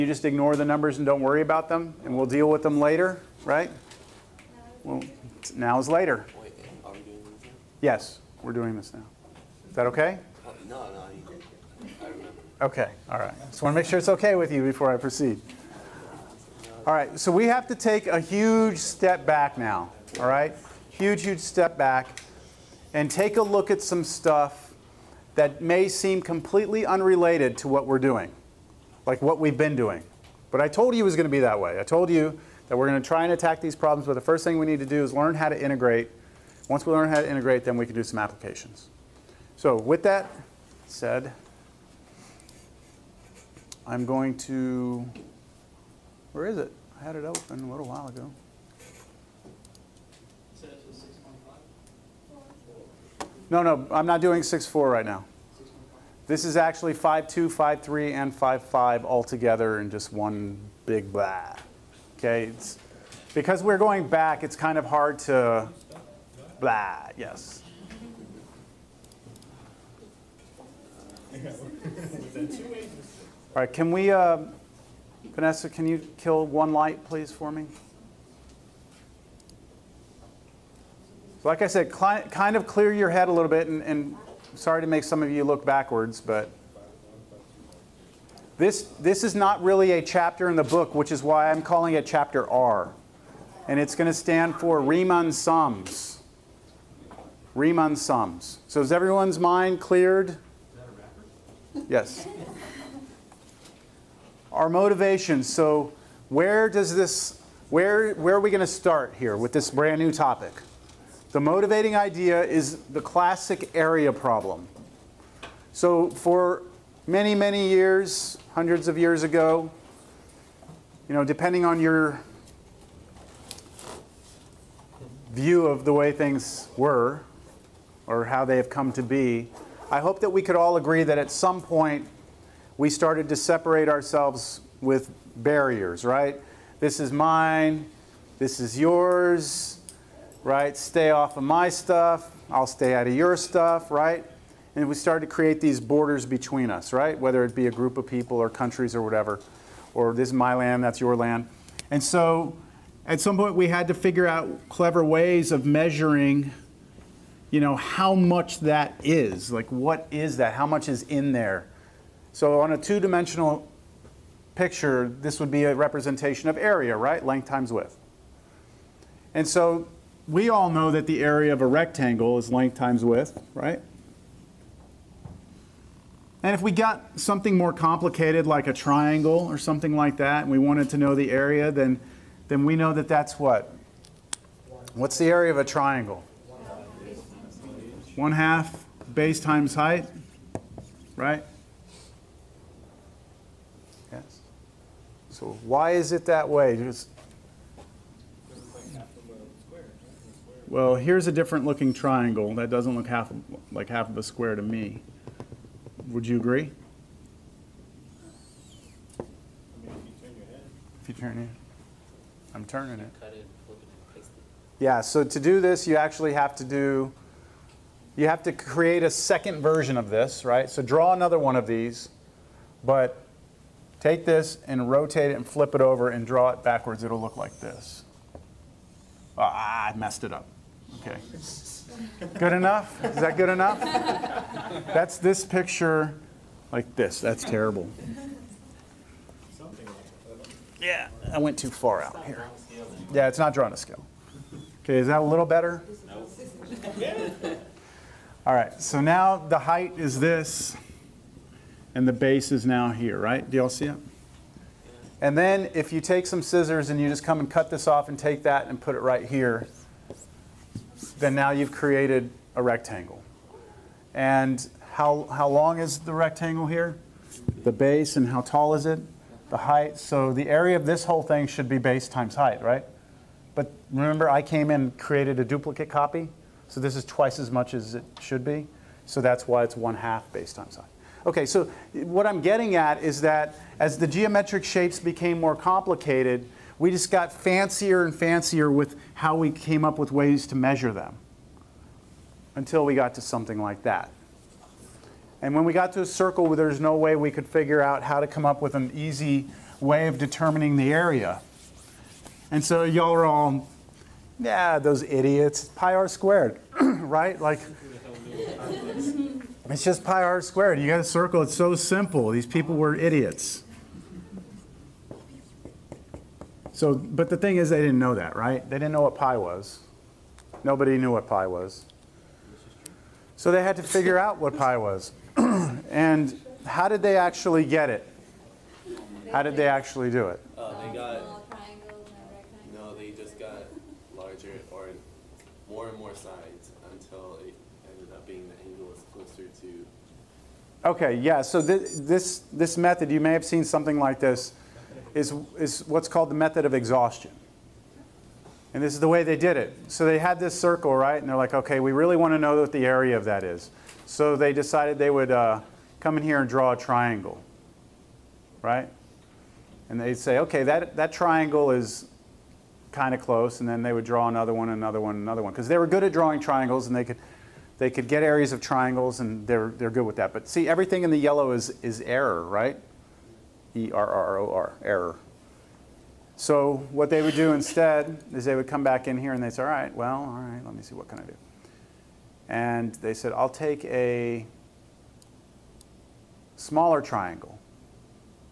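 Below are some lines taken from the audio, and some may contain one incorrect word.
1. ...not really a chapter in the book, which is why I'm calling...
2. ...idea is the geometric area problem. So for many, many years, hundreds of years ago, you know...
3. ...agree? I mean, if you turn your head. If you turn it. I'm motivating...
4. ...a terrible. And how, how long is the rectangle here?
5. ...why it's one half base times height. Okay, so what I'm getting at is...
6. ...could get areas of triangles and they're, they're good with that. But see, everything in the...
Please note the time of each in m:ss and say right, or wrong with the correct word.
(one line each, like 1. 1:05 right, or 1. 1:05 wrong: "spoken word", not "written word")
1. 1:29 right
2. 1:51 wrong: "classic", not "geometric"
3. 3:26 wrong: "turning", not "motivating"
4. 4:22 wrong: "rectangle", not "terrible"
5. 4:39 right
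6. 6:07 right.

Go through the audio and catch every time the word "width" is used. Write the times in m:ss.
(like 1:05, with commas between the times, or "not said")
2:47, 2:53.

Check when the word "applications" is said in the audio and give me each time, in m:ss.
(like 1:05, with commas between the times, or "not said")
0:38.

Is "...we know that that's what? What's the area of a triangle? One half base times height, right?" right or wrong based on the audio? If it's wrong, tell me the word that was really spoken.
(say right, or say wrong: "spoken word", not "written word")
right.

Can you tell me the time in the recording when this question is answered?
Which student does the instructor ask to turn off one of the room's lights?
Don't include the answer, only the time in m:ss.
1:15.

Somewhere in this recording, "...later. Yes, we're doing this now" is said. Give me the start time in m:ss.
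0:05.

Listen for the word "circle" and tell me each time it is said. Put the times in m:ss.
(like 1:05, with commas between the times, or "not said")
4:56, 5:11, 5:50.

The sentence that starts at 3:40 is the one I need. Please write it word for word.
So draw another one of these, but take this and rotate it and flip it over and draw it backwards.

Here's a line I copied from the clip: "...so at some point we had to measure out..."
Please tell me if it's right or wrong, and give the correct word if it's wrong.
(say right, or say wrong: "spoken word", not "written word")
wrong: "figure", not "measure".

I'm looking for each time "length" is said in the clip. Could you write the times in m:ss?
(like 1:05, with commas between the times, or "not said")
2:47, 2:52.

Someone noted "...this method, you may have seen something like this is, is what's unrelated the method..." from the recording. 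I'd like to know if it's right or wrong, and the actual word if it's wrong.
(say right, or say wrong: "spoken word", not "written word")
wrong: "called", not "unrelated".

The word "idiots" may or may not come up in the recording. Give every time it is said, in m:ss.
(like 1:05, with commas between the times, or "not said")
5:05, 5:12.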